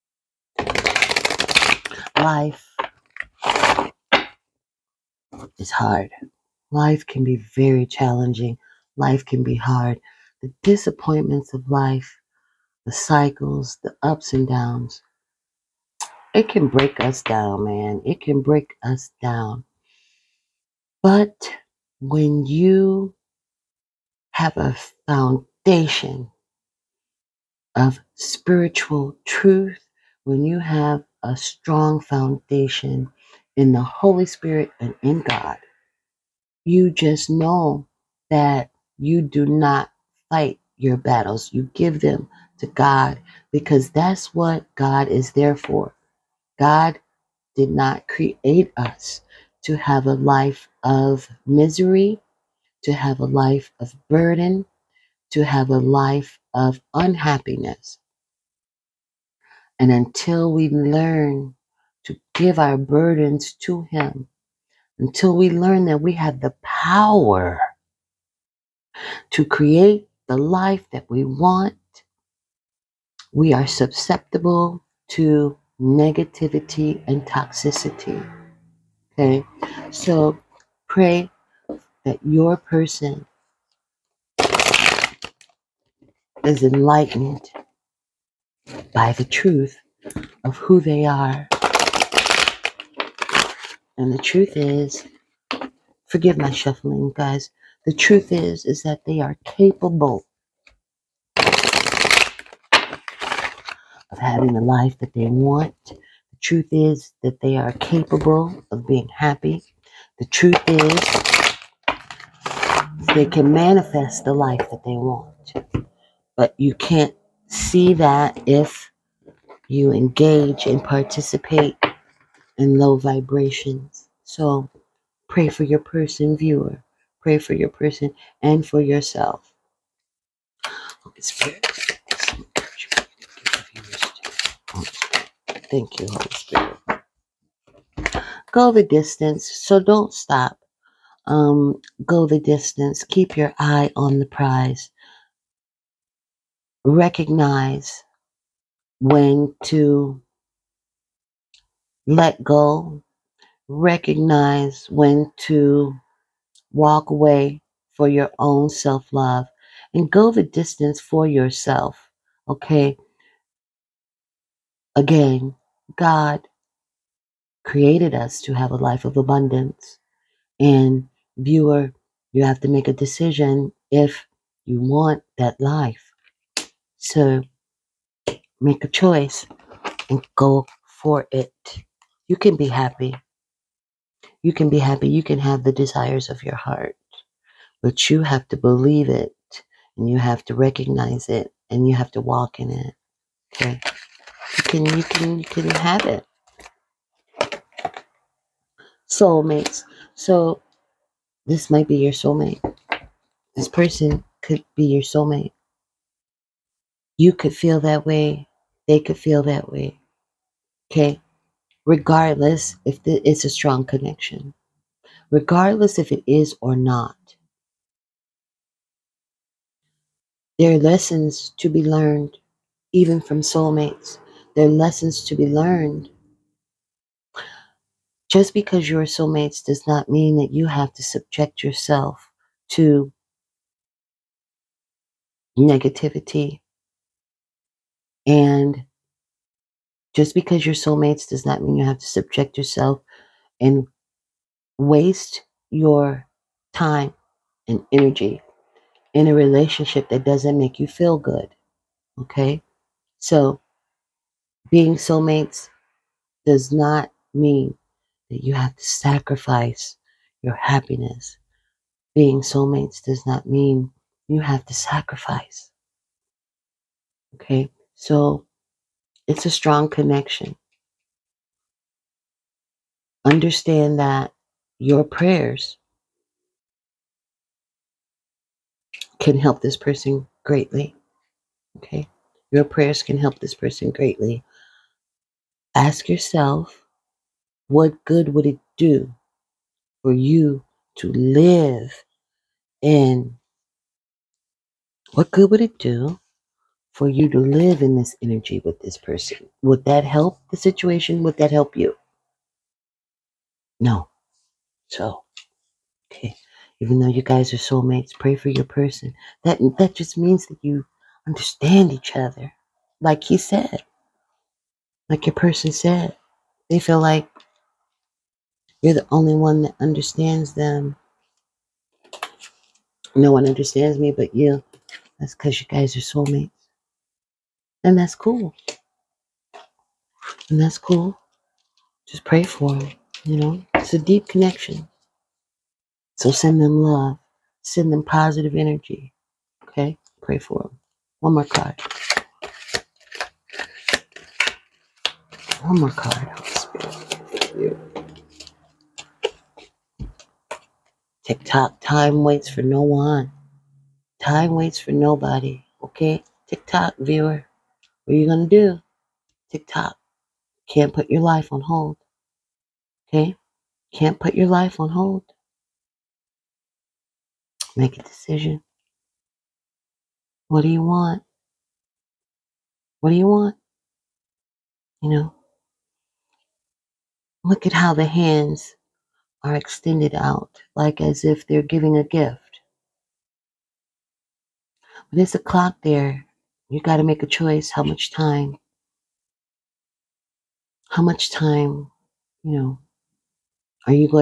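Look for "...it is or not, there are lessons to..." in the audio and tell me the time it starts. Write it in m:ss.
3:36.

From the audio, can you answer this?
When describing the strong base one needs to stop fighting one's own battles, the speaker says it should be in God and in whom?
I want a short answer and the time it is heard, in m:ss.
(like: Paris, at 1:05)
the Holy Spirit, at 0:33.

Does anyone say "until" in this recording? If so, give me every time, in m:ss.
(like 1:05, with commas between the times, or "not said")
0:59, 1:04.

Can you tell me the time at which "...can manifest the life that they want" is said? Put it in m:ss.
1:53.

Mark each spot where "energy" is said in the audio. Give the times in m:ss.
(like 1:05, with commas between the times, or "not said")
4:07, 4:58, 5:38.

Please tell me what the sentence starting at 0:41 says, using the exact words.
You give them to God because that's what God is there for.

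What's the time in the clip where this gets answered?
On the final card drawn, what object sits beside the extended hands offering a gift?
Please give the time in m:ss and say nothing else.
6:25.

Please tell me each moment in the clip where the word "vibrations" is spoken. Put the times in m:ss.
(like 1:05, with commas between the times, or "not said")
2:02.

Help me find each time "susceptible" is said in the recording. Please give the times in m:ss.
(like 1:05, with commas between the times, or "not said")
1:13.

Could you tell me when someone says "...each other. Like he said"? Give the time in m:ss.
5:11.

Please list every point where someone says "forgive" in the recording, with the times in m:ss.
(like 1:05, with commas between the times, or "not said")
1:36.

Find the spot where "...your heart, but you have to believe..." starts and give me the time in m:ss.
3:06.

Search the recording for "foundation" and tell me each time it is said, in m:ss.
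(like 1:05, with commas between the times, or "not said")
0:25, 0:32.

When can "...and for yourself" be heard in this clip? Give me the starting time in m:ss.
2:08.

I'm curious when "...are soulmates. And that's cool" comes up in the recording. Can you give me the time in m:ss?
5:25.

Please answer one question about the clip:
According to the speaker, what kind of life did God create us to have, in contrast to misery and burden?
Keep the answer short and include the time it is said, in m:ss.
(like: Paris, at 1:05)
a life of abundance, at 2:48.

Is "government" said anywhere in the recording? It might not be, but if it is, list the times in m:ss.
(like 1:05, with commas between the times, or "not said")
not said.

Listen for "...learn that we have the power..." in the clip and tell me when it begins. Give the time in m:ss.
1:05.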